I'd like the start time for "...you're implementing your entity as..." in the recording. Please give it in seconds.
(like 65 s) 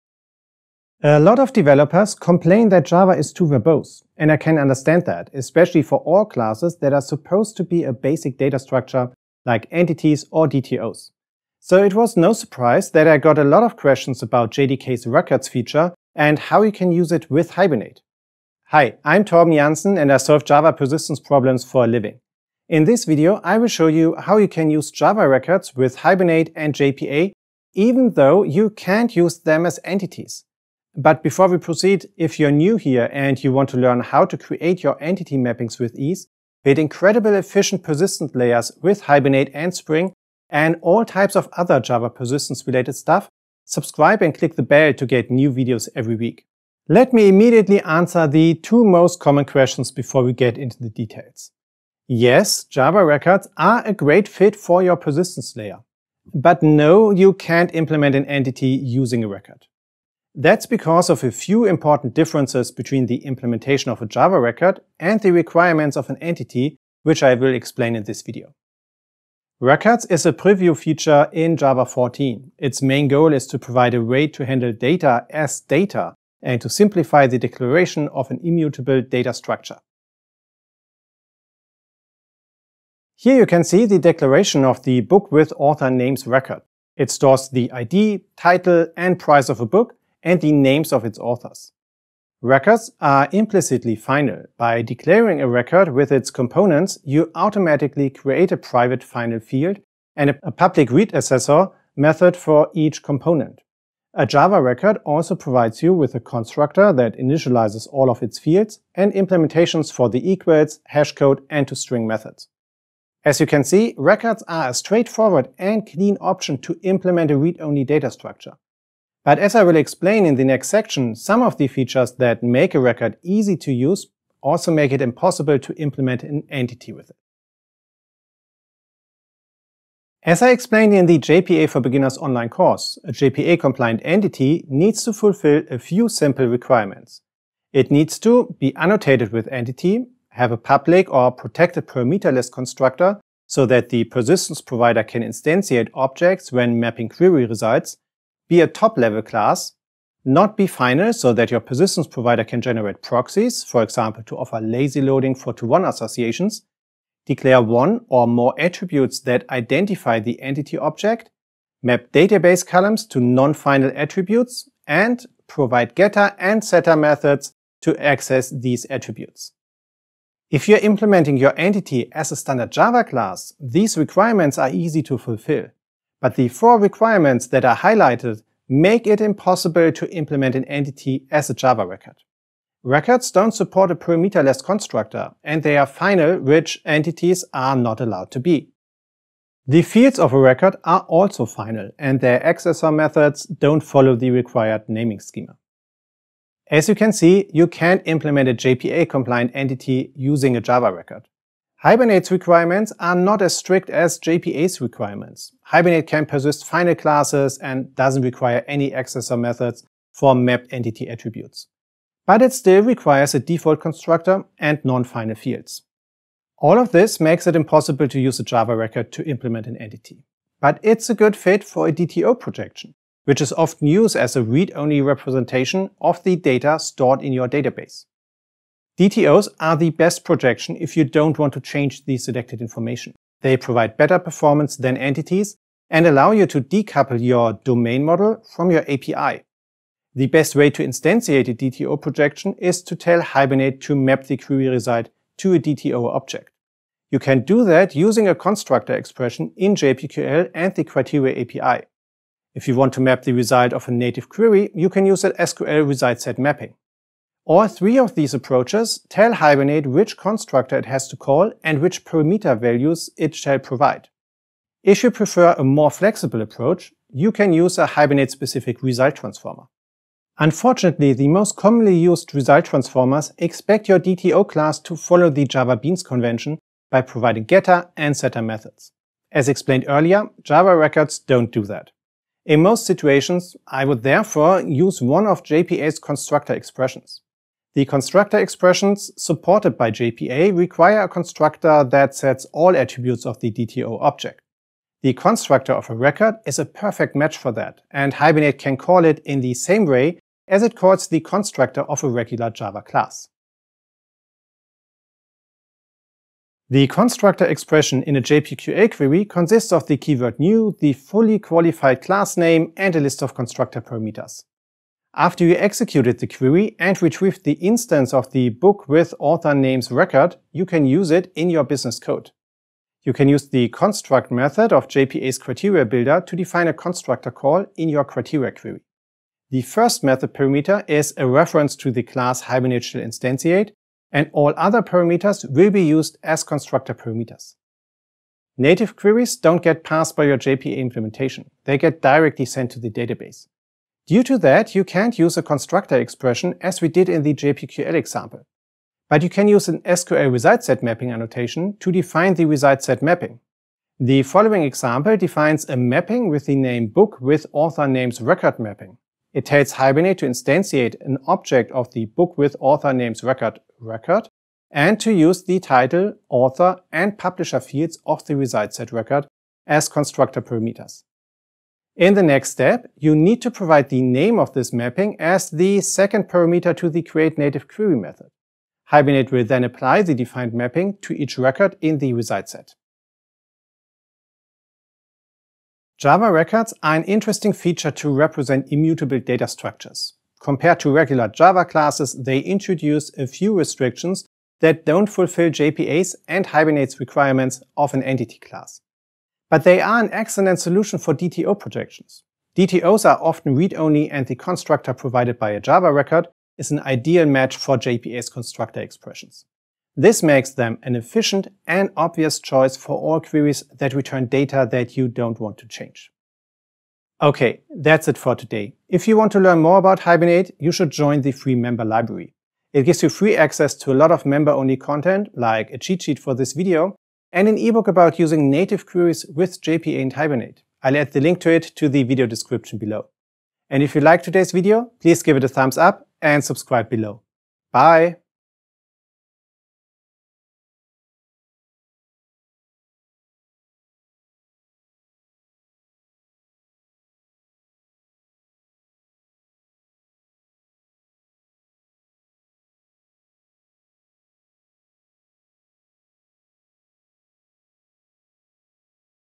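170 s.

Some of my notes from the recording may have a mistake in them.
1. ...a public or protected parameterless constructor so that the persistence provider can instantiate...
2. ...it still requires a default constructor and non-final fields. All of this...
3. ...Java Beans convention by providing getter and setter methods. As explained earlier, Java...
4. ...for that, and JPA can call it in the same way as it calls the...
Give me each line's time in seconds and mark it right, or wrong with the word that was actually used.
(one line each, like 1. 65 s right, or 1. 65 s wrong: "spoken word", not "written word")
1. 140 s right
2. 212 s right
3. 275 s right
4. 297 s wrong: "Hibernate", not "JPA".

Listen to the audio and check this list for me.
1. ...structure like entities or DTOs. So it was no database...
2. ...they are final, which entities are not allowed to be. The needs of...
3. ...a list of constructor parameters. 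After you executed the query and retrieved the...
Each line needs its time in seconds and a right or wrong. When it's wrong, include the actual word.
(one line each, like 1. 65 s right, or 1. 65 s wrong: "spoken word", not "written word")
1. 8 s wrong: "surprise", not "database"
2. 185 s wrong: "fields", not "needs"
3. 312 s right.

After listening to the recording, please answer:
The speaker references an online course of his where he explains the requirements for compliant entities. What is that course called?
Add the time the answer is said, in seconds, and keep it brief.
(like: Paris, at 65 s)
JPA for Beginners, at 131 s.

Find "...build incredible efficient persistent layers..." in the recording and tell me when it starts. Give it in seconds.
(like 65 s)
36 s.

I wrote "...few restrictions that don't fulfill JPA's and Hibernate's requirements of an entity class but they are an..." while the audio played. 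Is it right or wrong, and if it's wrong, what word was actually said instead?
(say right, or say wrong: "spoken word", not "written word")
right.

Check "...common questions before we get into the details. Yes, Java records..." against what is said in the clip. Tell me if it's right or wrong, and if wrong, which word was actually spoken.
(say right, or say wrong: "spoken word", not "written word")
right.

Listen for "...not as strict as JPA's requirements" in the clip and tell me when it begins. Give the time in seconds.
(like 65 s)
203 s.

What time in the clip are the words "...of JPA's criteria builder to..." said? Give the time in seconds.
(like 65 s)
324 s.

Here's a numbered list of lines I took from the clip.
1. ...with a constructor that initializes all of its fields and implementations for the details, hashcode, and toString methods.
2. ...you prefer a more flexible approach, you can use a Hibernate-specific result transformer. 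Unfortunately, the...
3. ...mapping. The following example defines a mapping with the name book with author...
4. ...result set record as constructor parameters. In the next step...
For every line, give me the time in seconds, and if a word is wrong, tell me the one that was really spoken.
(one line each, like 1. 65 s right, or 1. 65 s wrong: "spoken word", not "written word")
1. 105 s wrong: "equals", not "details"
2. 265 s right
3. 353 s right
4. 368 s right.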